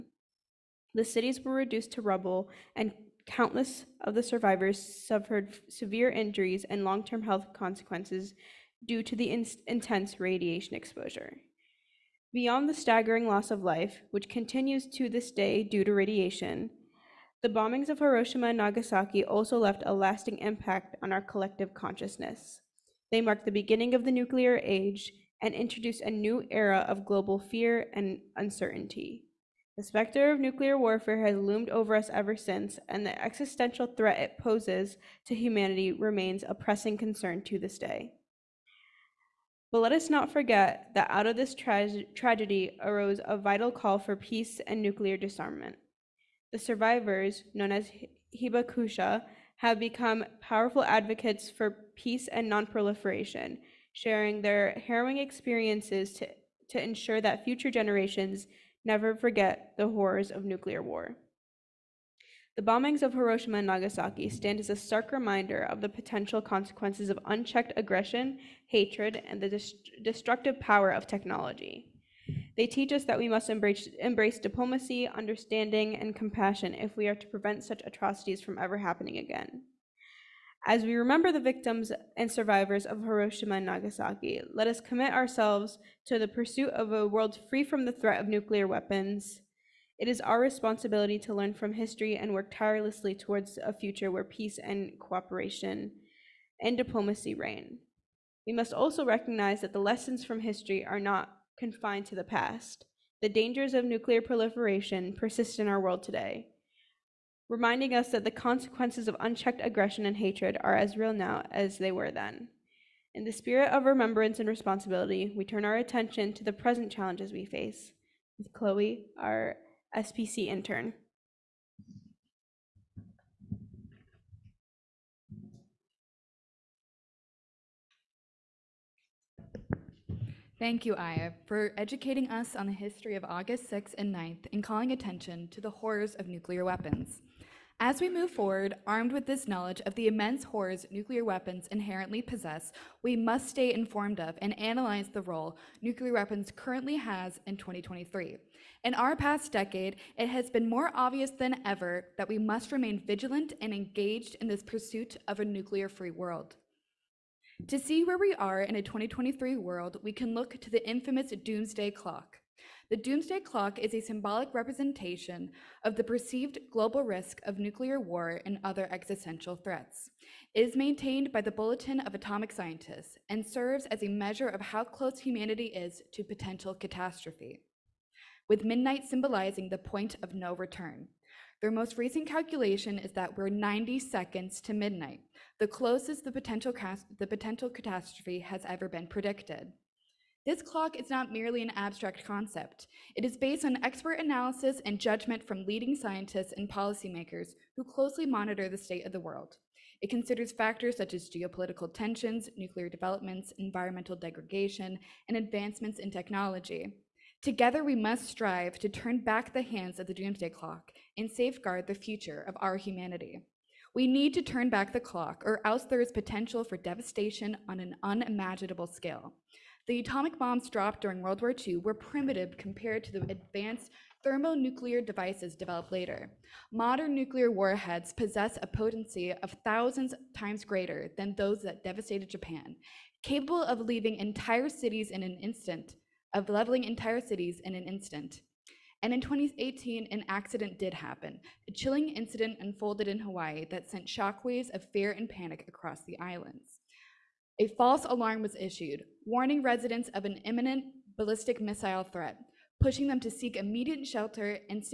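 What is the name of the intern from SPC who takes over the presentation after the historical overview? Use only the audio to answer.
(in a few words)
Chloe.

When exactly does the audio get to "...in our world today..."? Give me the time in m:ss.
1:45.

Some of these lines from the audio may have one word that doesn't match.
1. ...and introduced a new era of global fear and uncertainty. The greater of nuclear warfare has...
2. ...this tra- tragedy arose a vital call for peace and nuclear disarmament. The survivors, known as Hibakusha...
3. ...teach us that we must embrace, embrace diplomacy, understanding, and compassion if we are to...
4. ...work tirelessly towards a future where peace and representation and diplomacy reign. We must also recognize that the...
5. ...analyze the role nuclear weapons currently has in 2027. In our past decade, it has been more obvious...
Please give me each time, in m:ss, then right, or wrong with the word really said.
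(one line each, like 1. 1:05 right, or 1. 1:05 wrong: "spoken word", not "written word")
1. 0:25 wrong: "specter", not "greater"
2. 0:41 right
3. 1:12 right
4. 1:32 wrong: "cooperation", not "representation"
5. 2:24 wrong: "2023", not "2027".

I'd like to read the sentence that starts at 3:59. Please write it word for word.
And in 2018, an accident did happen.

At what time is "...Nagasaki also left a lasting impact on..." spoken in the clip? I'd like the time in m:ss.
0:18.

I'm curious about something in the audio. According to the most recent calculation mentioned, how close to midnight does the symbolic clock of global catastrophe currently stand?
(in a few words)
90 seconds.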